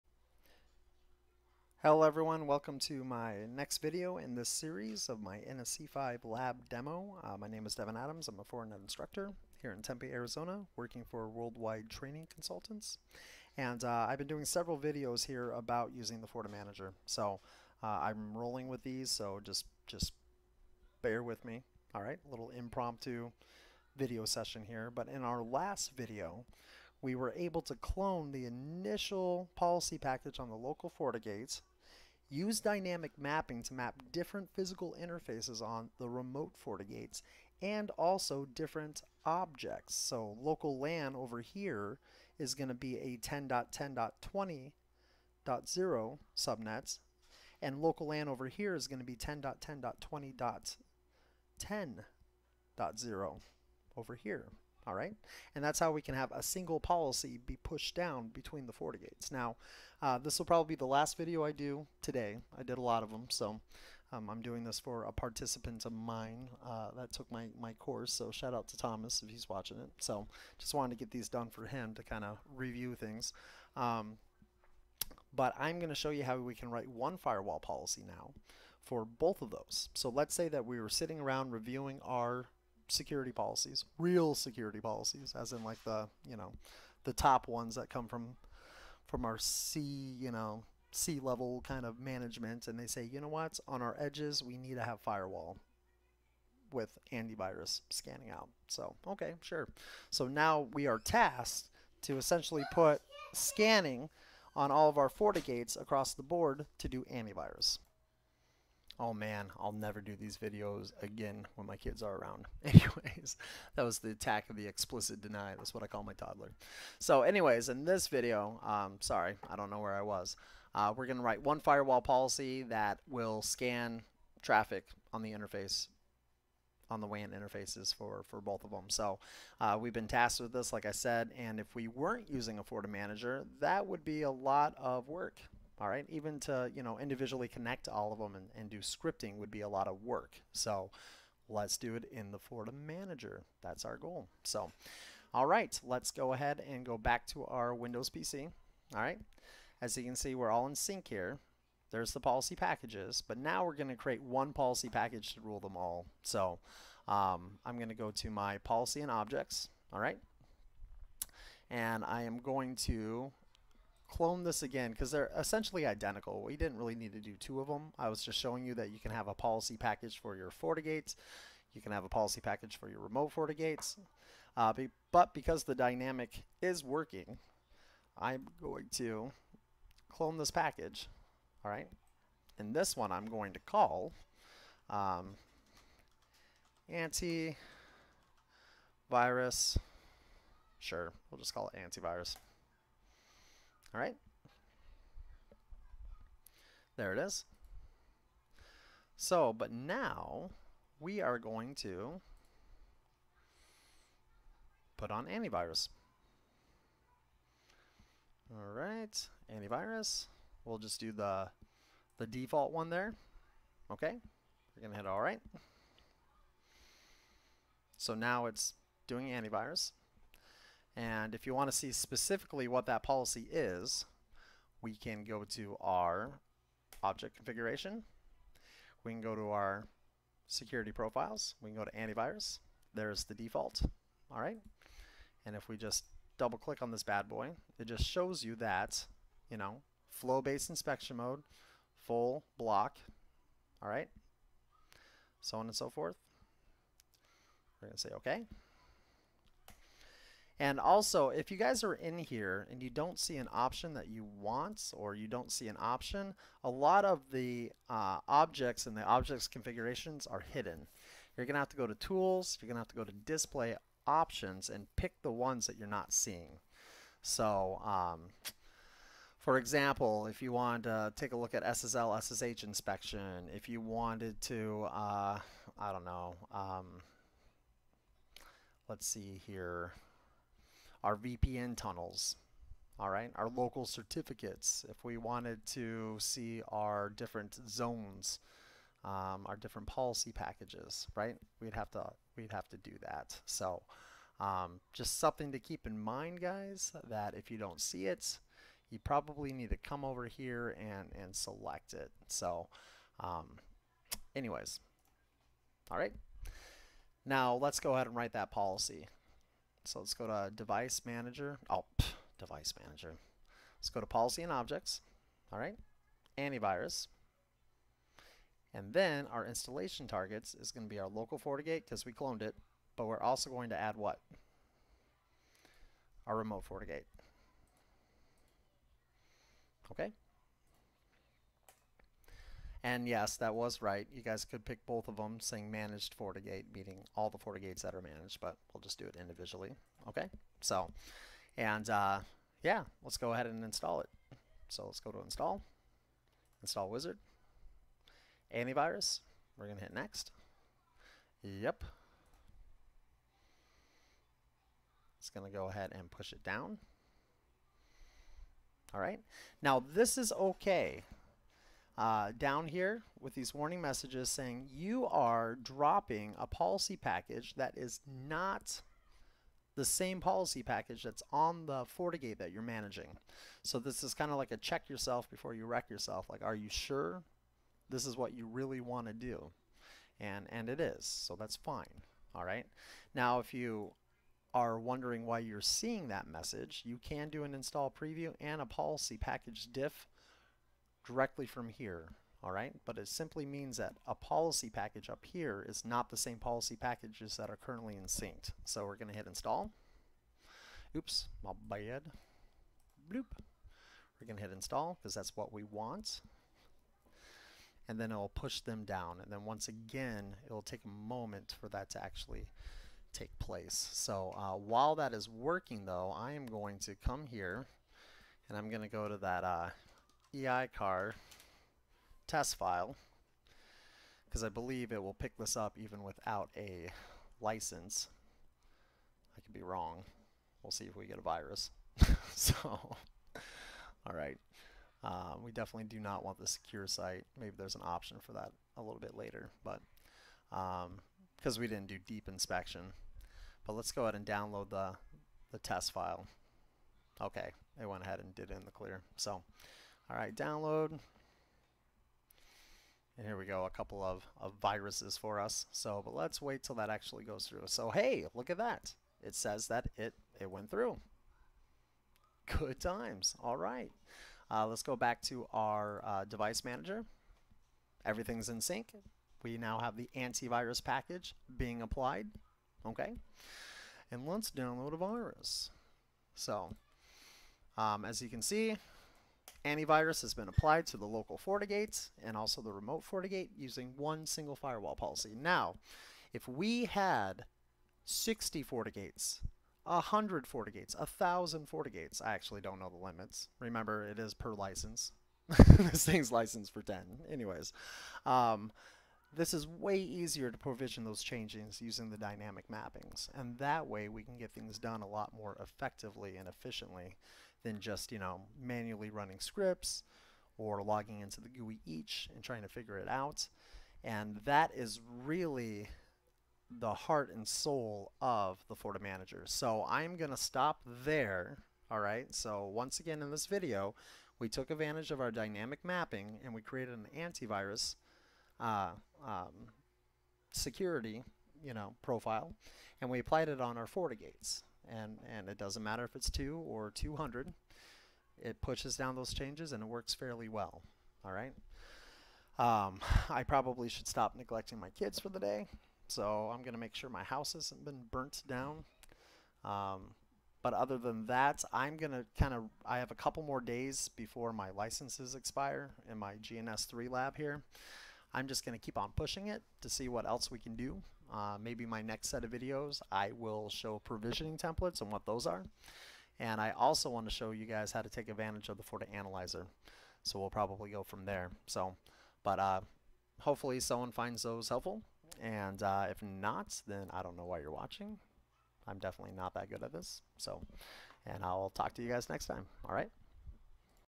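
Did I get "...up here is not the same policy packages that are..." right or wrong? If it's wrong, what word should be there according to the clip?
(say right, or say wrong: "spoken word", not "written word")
right.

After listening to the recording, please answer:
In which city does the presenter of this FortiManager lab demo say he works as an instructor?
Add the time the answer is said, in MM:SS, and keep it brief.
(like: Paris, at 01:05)
Tempe, Arizona, at 00:09.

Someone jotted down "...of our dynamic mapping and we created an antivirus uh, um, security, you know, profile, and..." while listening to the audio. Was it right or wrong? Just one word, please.
right.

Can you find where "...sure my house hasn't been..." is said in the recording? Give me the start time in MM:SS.
09:06.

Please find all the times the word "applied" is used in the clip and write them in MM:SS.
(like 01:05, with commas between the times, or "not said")
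07:51, 08:00, 08:53.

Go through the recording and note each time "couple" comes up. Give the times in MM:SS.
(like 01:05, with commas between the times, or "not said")
07:33, 09:13.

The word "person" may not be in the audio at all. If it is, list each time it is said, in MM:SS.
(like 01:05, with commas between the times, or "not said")
not said.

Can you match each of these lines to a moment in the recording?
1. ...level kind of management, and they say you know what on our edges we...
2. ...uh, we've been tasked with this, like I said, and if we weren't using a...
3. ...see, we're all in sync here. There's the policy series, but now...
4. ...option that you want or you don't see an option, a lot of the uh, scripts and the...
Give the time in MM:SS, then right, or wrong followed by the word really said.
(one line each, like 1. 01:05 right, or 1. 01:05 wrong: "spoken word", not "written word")
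1. 01:31 right
2. 02:09 right
3. 02:30 wrong: "packages", not "series"
4. 04:13 wrong: "objects", not "scripts".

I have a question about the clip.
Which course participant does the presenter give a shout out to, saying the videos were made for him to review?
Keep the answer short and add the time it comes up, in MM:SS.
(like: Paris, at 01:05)
Thomas, at 01:08.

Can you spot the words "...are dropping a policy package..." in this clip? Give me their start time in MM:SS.
06:05.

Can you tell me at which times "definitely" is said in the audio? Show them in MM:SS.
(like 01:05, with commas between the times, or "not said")
07:15, 09:38.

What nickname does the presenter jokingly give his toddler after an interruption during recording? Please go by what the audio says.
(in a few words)
The explicit deny.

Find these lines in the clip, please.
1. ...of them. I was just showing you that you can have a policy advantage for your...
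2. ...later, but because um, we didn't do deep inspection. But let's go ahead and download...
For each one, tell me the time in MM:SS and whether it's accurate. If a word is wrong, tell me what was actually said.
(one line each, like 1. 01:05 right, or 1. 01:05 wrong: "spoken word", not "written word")
1. 02:47 wrong: "package", not "advantage"
2. 07:19 right.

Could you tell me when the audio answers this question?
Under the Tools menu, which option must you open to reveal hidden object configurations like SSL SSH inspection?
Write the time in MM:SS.
04:23.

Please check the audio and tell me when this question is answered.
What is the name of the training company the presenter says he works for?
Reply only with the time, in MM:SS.
00:11.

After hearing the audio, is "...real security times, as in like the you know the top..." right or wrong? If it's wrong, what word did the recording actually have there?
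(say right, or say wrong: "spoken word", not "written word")
wrong: "policies", not "times".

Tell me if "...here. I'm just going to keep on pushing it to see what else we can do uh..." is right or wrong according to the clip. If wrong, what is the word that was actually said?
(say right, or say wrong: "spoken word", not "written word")
right.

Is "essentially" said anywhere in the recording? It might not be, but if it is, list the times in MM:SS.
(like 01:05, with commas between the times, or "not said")
01:42, 02:45.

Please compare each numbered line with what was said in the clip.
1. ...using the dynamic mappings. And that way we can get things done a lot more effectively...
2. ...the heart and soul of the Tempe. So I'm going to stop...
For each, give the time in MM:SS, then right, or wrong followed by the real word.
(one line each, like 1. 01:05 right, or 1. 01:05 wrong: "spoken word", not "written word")
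1. 08:21 right
2. 08:36 wrong: "FortiManager", not "Tempe".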